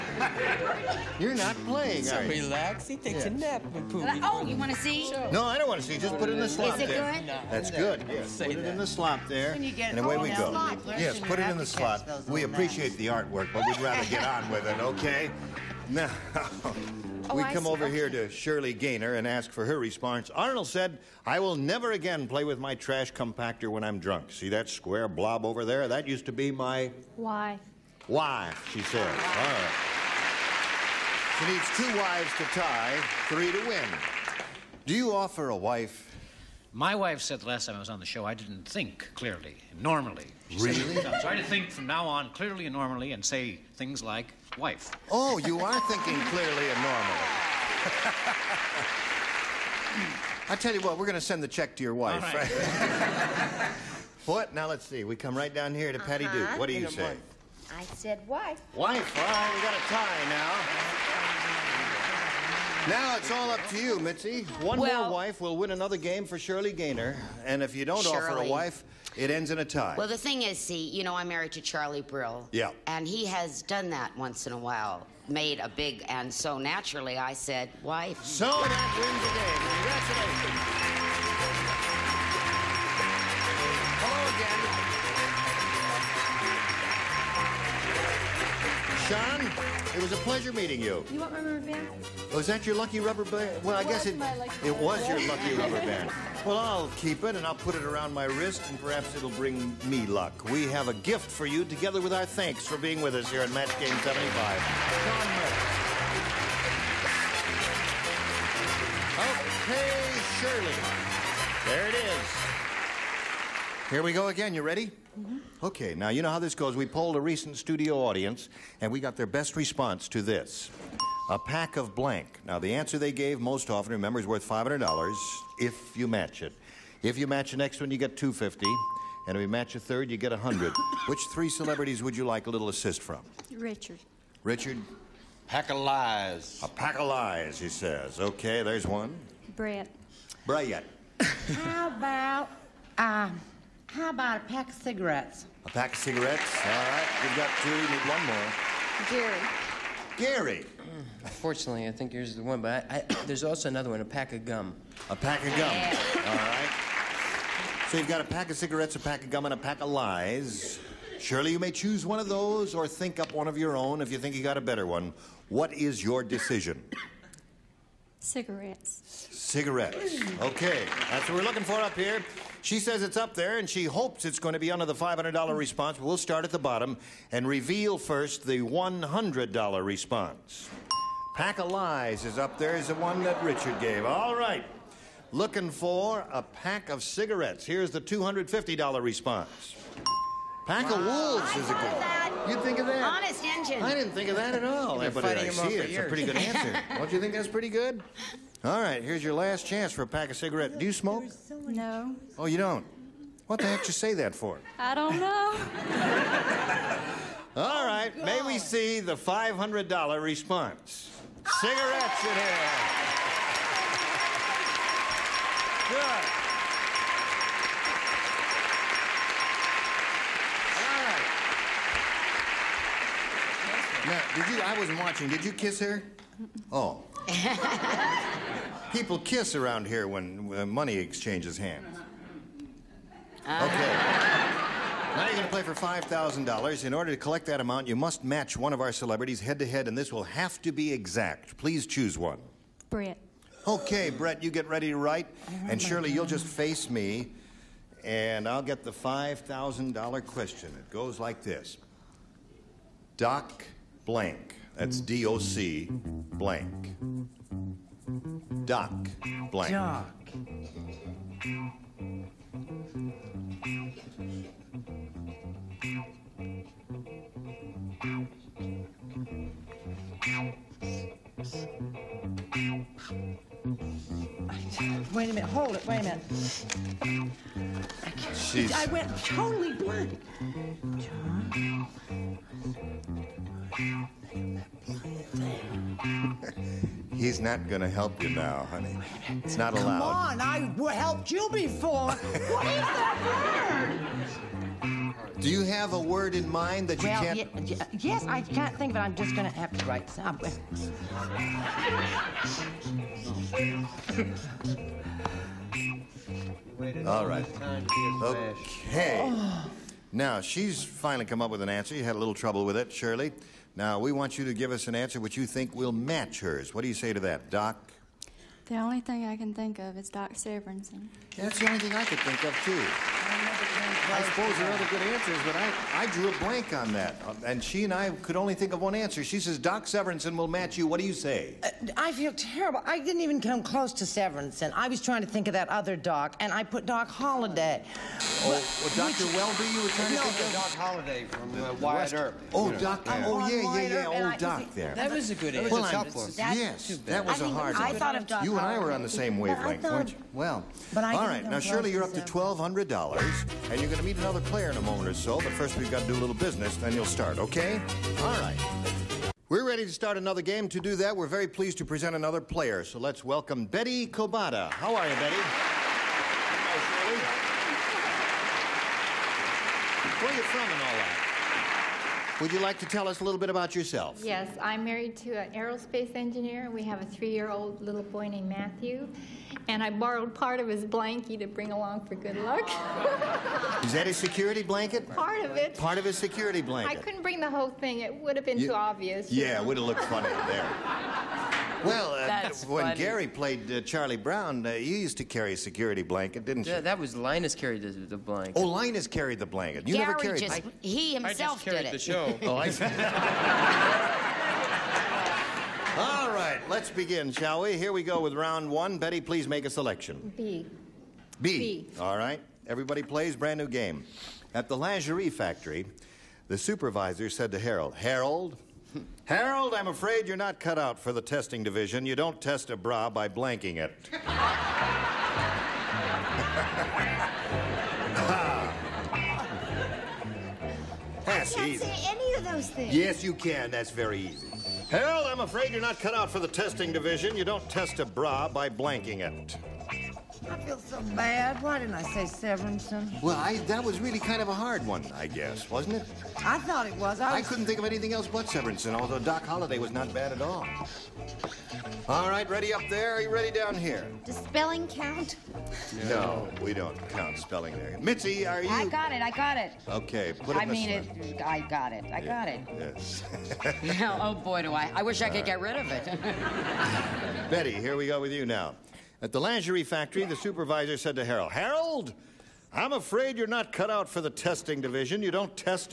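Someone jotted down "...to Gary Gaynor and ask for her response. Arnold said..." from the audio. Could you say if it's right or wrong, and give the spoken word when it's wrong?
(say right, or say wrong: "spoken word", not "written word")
wrong: "Shirley", not "Gary".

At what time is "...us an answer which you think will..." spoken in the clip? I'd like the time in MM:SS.
05:14.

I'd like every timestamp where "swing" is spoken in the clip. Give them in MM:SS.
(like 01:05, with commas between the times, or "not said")
not said.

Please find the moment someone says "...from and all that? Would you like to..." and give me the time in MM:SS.
06:10.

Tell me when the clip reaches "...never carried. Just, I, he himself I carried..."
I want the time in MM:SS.
06:40.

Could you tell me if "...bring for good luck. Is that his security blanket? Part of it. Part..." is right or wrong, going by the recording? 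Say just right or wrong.
wrong.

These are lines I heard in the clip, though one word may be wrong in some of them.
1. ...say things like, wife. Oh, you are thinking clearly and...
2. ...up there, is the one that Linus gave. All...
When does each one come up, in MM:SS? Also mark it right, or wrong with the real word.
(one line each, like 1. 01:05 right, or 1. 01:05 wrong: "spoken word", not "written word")
1. 00:43 right
2. 03:02 wrong: "Richard", not "Linus".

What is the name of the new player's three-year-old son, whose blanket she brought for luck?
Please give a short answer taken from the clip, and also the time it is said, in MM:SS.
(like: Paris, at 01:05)
Matthew, at 06:18.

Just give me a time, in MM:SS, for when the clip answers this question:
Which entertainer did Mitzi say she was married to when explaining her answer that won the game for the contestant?
01:11.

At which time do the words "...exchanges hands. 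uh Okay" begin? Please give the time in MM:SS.
03:50.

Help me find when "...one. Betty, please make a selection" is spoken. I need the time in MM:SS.
06:48.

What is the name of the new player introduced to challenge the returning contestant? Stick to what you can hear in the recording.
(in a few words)
Betty Kobata.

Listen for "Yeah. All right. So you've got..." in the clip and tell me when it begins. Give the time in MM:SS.
02:35.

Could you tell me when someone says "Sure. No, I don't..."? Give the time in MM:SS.
00:05.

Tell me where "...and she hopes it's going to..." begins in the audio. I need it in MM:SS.
02:53.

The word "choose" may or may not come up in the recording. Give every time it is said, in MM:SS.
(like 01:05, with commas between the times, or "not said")
02:41, 04:01.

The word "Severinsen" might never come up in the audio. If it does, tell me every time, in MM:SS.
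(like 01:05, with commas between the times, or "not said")
05:20, 05:29, 05:34, 07:22, 07:28.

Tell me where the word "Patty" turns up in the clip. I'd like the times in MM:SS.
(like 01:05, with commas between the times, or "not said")
00:55.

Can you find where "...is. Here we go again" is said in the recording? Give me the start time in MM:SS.
01:51.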